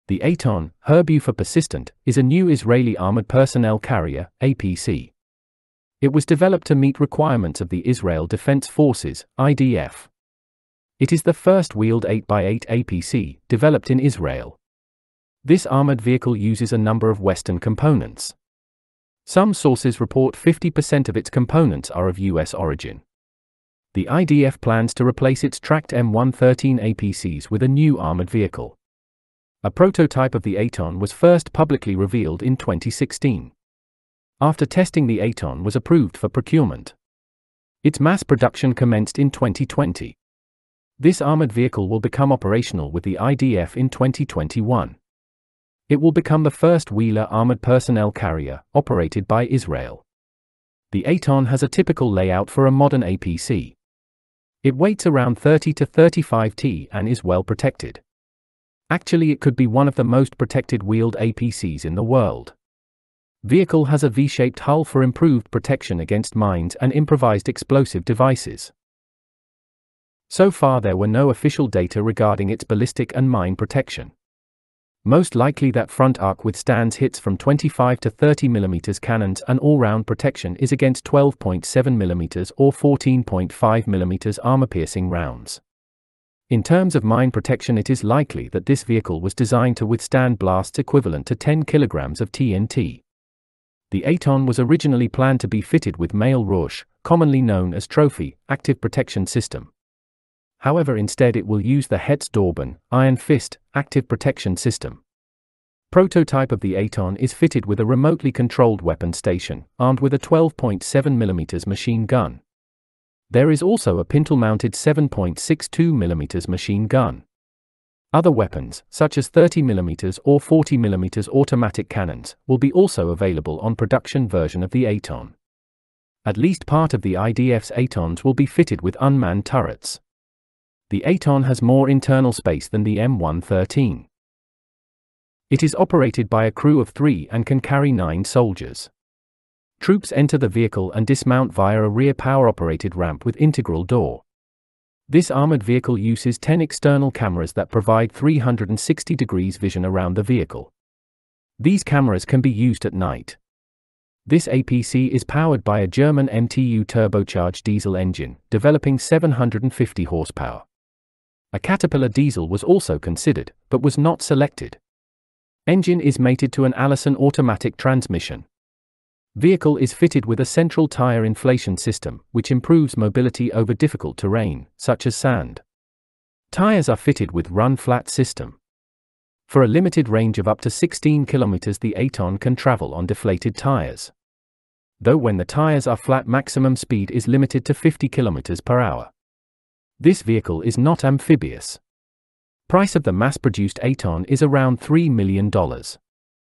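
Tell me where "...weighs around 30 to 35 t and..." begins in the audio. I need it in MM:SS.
00:54.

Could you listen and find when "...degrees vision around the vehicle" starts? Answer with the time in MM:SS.
02:29.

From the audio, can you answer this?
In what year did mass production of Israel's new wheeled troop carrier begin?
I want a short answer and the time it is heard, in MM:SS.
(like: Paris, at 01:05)
2020, at 00:39.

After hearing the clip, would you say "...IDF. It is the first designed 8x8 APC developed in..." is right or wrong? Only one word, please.
wrong.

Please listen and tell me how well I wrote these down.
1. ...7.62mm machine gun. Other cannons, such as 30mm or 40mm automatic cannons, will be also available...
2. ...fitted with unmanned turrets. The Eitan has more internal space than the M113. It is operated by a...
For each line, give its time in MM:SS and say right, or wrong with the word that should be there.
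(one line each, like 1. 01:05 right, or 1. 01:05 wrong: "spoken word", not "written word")
1. 01:54 wrong: "weapons", not "cannons"
2. 02:08 right.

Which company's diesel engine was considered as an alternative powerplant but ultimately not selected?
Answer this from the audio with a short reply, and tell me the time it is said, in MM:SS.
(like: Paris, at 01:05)
Caterpillar, at 02:41.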